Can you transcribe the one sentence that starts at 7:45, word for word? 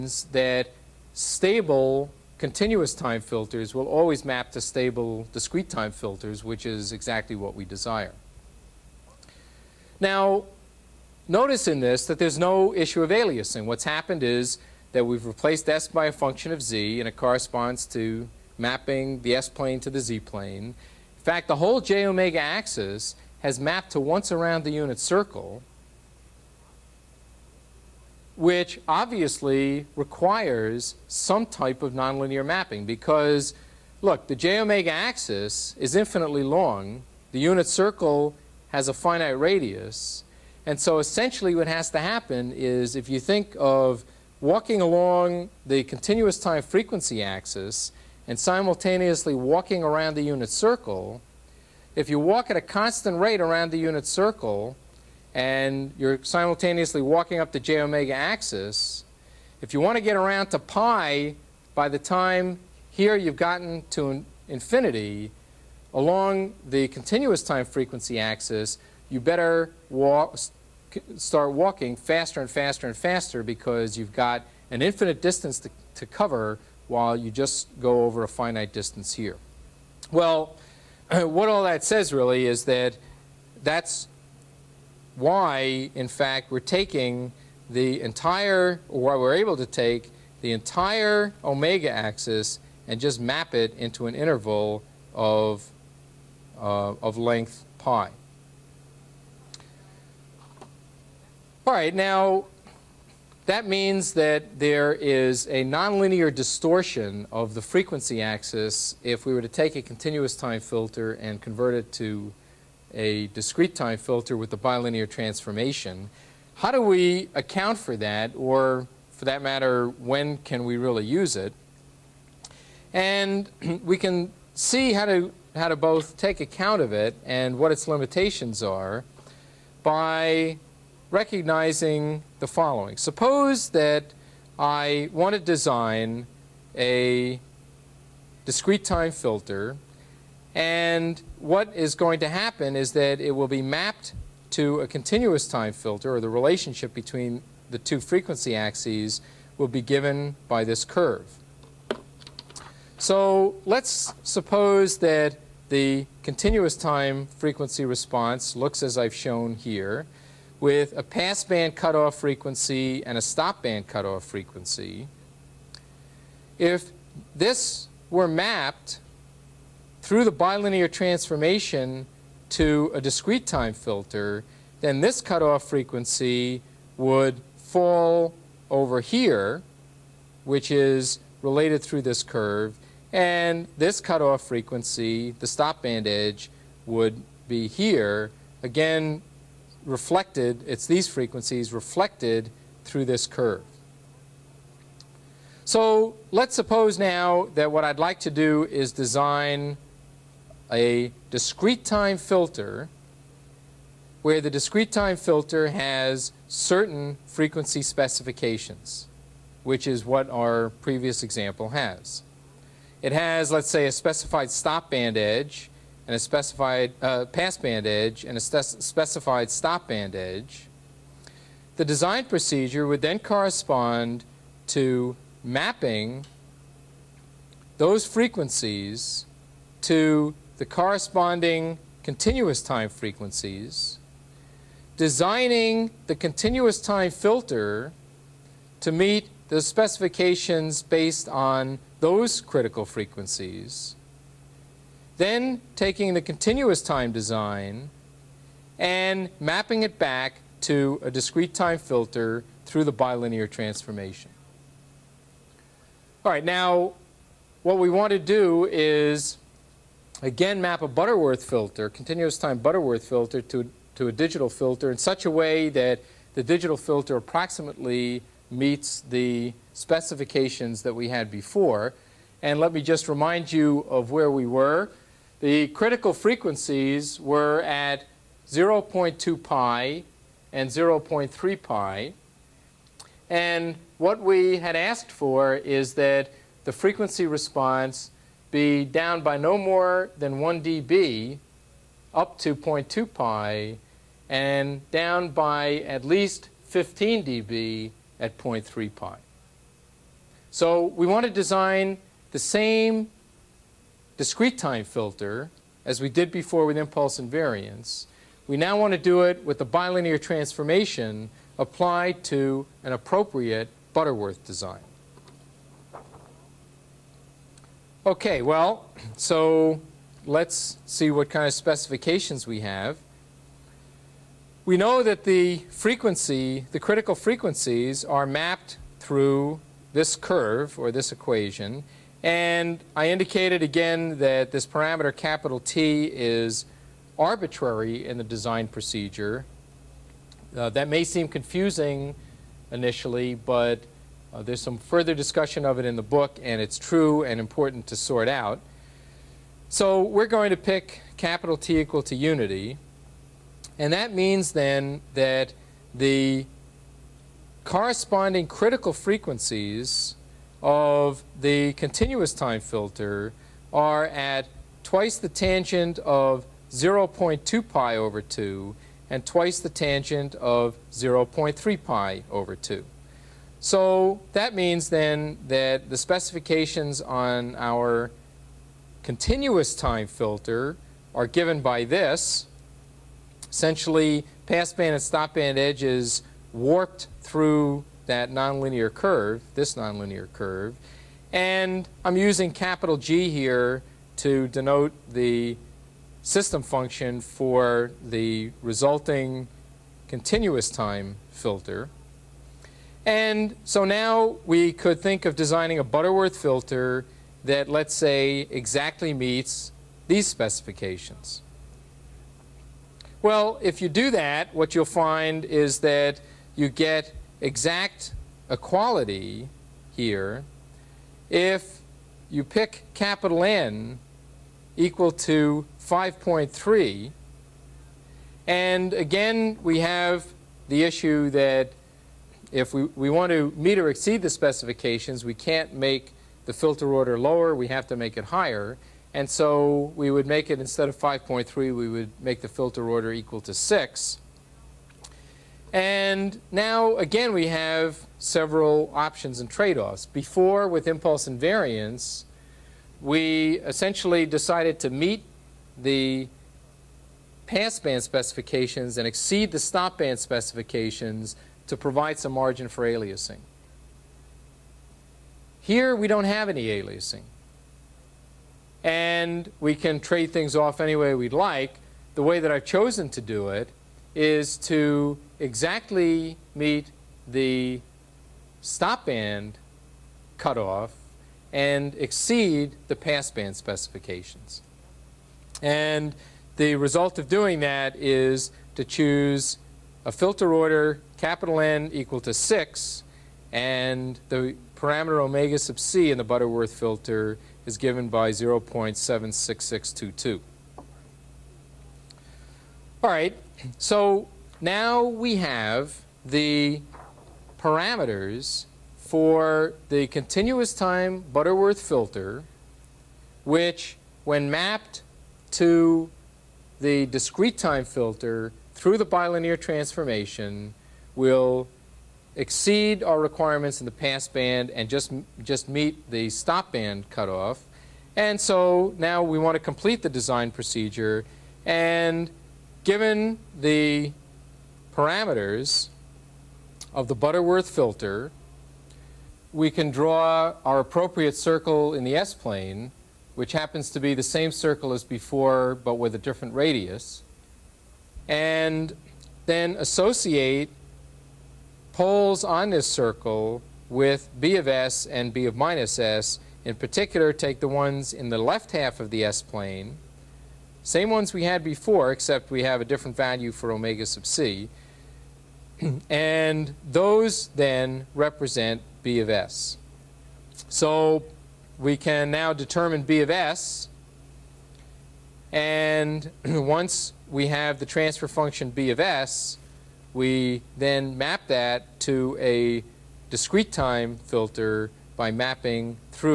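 Here we don't have any aliasing.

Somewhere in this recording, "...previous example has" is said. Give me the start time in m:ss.
3:30.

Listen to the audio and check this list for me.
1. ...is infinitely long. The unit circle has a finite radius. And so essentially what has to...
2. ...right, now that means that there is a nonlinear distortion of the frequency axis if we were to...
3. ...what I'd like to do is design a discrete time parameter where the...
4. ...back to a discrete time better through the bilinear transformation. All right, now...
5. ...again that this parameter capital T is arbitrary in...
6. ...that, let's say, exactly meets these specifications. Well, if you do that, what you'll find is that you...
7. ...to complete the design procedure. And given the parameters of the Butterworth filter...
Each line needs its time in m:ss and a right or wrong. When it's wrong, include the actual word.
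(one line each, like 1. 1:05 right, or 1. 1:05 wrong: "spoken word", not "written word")
1. 0:35 right
2. 1:41 right
3. 3:17 wrong: "filter", not "parameter"
4. 4:09 wrong: "filter", not "better"
5. 5:33 right
6. 6:47 right
7. 8:49 right.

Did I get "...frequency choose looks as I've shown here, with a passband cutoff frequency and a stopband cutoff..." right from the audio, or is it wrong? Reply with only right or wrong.
wrong.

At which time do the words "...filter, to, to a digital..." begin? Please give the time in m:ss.
4:23.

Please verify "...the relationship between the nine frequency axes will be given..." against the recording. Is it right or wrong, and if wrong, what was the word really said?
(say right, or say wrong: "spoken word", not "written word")
wrong: "two", not "nine".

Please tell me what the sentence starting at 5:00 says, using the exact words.
So we want to design the same discrete time filter as we did before with impulse invariance.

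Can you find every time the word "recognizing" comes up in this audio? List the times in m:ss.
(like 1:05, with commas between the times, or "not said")
2:11.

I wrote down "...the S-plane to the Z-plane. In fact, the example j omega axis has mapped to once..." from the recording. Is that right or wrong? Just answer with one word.
wrong.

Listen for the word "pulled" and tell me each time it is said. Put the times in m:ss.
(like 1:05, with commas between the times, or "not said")
not said.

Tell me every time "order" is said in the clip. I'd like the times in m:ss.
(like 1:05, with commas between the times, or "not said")
7:16, 7:22, 8:10.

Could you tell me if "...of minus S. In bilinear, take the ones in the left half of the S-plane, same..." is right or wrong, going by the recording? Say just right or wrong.
wrong.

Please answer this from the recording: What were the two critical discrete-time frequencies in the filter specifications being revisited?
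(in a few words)
0.2 pi and 0.3 pi.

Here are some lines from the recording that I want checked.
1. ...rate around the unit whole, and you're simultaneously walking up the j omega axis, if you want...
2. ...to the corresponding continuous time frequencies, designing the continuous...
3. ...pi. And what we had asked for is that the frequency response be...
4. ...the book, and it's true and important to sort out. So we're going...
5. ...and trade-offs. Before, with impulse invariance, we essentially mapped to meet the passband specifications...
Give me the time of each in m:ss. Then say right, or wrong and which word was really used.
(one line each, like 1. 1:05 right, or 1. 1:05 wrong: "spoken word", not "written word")
1. 0:53 wrong: "circle", not "whole"
2. 3:49 right
3. 4:41 right
4. 5:45 right
5. 7:29 wrong: "decided", not "mapped".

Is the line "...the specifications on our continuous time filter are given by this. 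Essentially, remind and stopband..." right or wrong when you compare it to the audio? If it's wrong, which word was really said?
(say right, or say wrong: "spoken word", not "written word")
wrong: "passband", not "remind".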